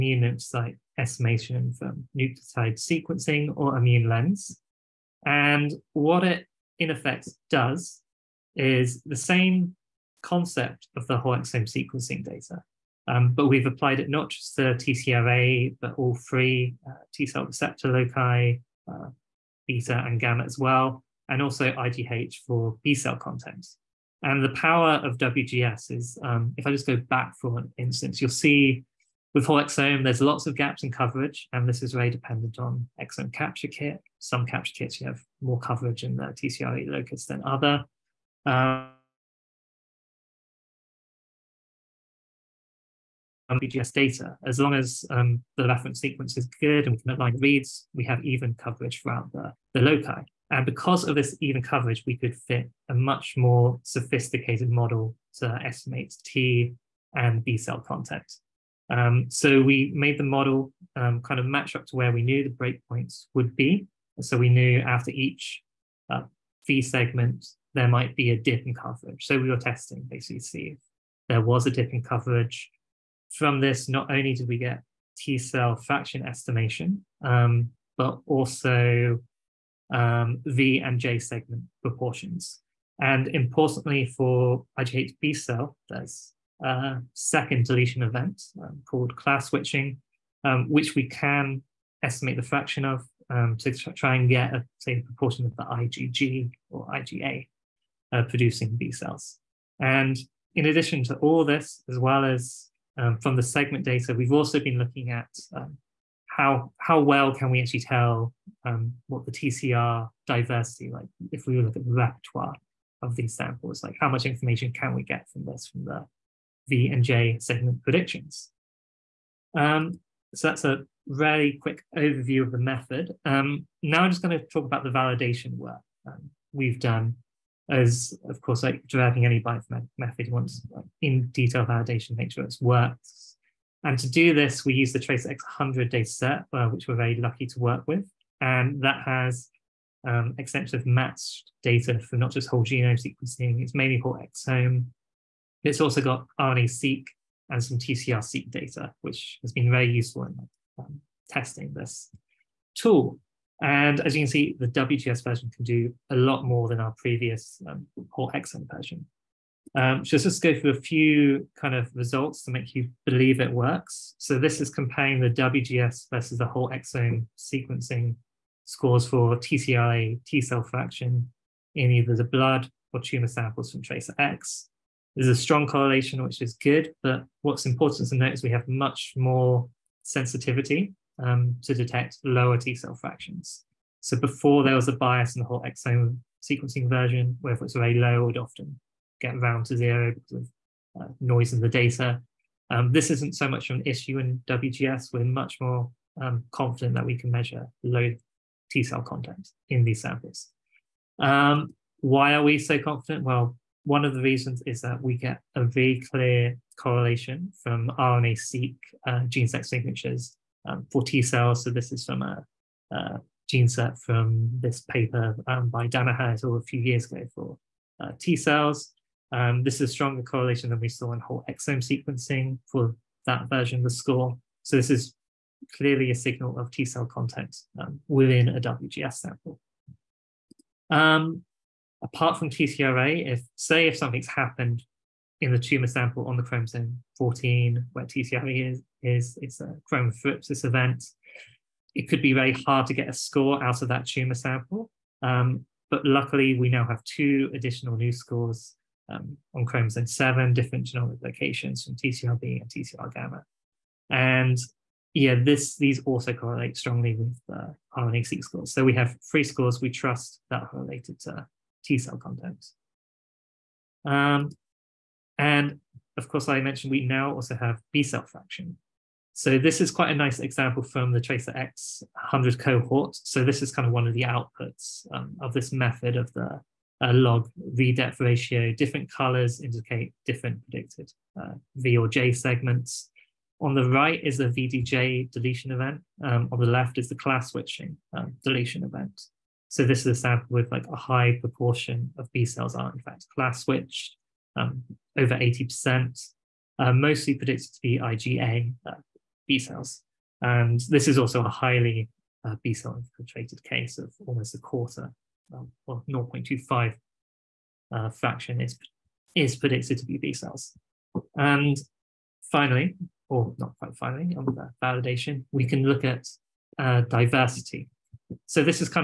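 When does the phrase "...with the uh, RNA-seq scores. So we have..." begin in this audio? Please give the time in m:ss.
4:17.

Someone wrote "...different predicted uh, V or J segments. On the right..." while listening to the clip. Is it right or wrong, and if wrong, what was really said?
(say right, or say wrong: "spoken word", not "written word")
right.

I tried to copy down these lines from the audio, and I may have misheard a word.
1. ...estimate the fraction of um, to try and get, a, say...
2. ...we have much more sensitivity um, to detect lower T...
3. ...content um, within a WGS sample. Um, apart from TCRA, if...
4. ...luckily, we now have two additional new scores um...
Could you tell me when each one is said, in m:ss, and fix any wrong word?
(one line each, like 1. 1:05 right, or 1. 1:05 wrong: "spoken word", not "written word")
1. 1:32 right
2. 2:58 right
3. 3:47 right
4. 4:06 right.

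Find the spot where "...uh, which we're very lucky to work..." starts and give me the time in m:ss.
2:16.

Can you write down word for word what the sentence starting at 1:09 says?
So we were testing basically to see if there was a dip in coverage.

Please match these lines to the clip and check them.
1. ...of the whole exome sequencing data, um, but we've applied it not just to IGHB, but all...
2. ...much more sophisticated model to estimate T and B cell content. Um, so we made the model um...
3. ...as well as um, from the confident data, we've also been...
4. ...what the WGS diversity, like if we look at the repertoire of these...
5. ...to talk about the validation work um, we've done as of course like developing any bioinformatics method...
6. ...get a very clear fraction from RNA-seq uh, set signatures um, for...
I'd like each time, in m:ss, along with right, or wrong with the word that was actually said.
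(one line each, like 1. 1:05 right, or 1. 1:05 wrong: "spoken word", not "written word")
1. 0:10 wrong: "TCRA", not "IGHB"
2. 0:52 right
3. 1:41 wrong: "segment", not "confident"
4. 1:49 wrong: "TCR", not "WGS"
5. 2:04 right
6. 3:25 wrong: "correlation", not "fraction".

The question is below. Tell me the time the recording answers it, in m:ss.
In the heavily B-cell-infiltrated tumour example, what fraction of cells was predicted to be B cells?
5:05.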